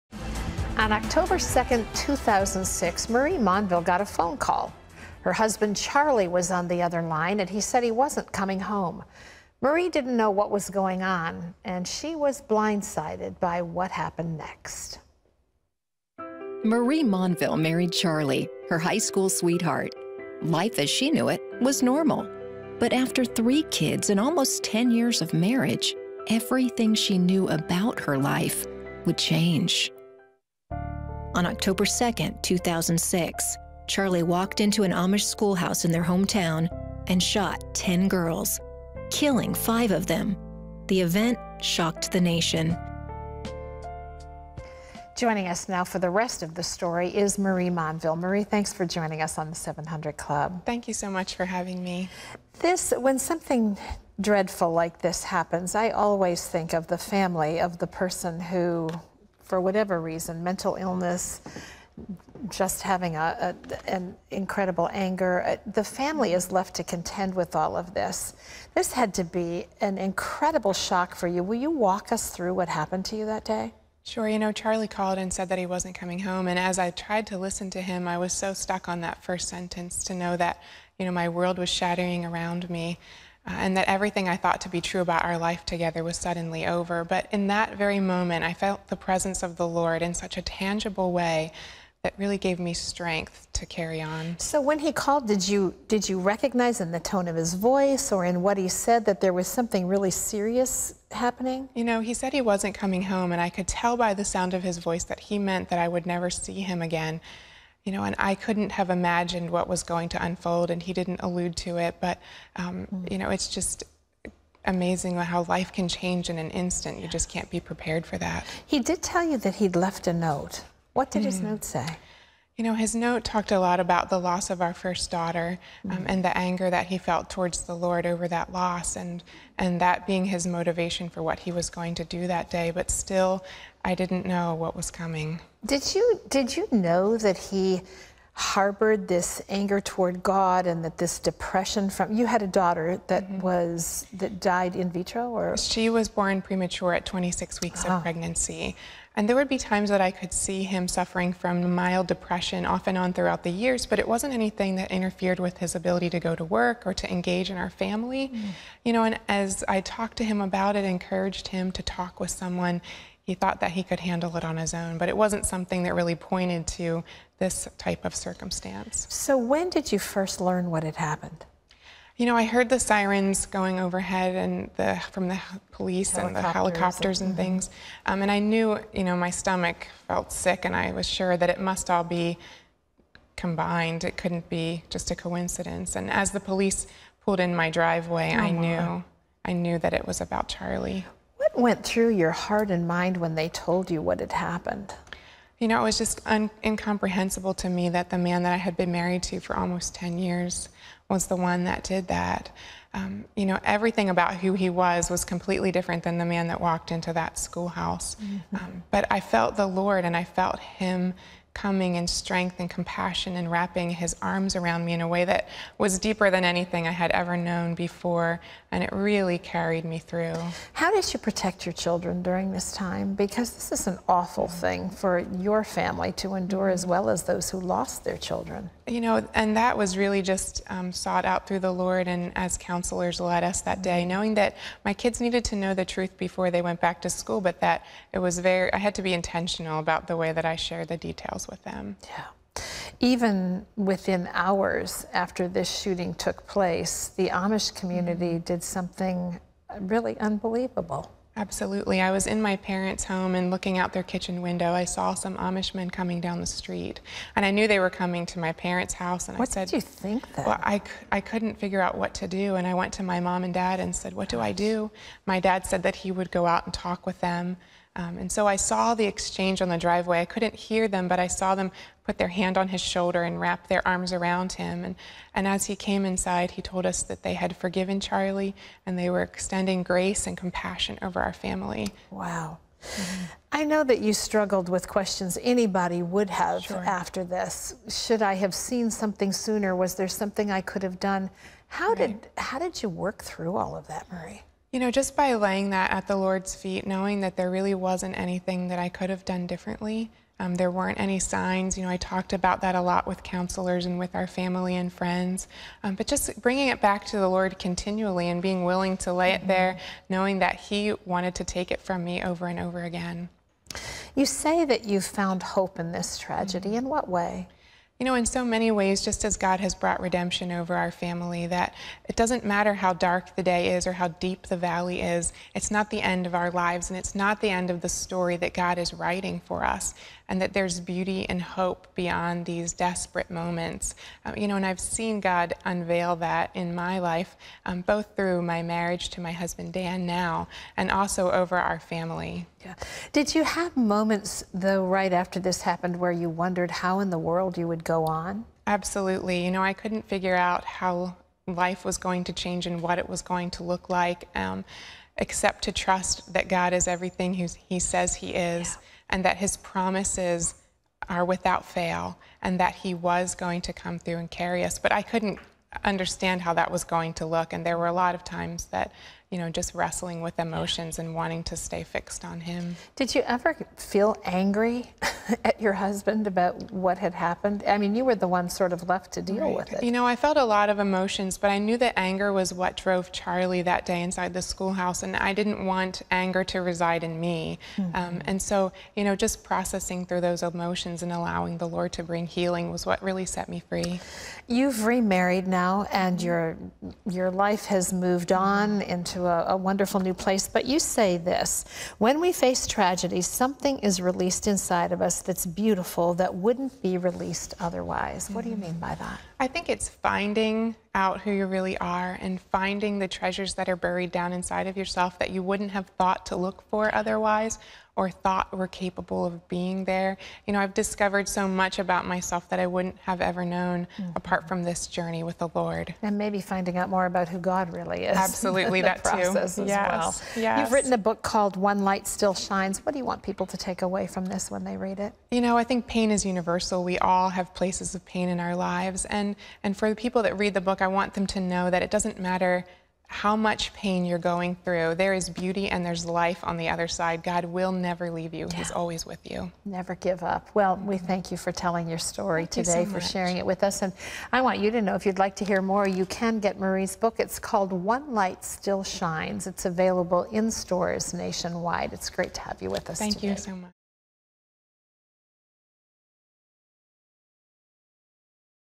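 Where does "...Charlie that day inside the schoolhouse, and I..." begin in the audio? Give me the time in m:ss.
6:23.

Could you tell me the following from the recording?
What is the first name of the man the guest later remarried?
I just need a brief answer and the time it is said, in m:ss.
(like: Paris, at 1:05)
Dan, at 5:39.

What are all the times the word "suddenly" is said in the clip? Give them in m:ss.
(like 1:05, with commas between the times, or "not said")
1:26.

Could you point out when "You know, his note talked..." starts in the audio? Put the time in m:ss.
2:02.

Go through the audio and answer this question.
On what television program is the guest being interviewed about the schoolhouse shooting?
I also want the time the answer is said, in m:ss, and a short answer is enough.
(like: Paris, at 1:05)
The 700 Club, at 0:49.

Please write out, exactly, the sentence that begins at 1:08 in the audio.
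This had to be an incredible shock for you.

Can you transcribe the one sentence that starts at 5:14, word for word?
You say that you found hope in this tragedy.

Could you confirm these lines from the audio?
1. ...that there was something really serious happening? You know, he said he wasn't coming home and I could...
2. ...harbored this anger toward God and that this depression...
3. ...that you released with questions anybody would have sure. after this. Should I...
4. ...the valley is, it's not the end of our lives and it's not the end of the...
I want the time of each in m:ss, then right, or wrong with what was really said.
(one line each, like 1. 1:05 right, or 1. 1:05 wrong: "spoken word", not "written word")
1. 1:39 right
2. 2:18 right
3. 4:43 wrong: "struggled", not "released"
4. 5:24 right.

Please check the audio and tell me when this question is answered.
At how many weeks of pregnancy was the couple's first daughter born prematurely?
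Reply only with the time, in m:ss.
2:27.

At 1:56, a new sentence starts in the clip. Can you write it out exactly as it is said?
You just can't be prepared for that.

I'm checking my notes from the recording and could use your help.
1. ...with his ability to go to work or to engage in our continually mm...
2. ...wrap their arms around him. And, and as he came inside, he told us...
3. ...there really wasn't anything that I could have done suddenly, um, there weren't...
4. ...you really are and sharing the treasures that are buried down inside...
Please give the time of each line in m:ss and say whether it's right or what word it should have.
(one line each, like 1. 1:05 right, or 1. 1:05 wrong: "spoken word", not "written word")
1. 2:35 wrong: "family", not "continually"
2. 4:33 right
3. 4:57 wrong: "differently", not "suddenly"
4. 6:51 wrong: "finding", not "sharing".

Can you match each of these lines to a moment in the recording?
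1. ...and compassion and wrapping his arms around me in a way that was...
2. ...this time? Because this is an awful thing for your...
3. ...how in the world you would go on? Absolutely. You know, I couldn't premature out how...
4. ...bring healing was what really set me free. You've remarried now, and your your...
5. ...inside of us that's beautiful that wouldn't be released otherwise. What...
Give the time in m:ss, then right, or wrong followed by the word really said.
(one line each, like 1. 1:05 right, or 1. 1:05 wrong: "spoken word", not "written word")
1. 3:32 right
2. 3:42 right
3. 5:46 wrong: "figure", not "premature"
4. 6:32 right
5. 6:44 right.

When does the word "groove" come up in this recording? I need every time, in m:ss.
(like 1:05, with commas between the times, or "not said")
not said.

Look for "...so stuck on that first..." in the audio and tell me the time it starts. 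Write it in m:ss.
1:18.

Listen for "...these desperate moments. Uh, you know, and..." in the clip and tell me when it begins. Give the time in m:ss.
5:32.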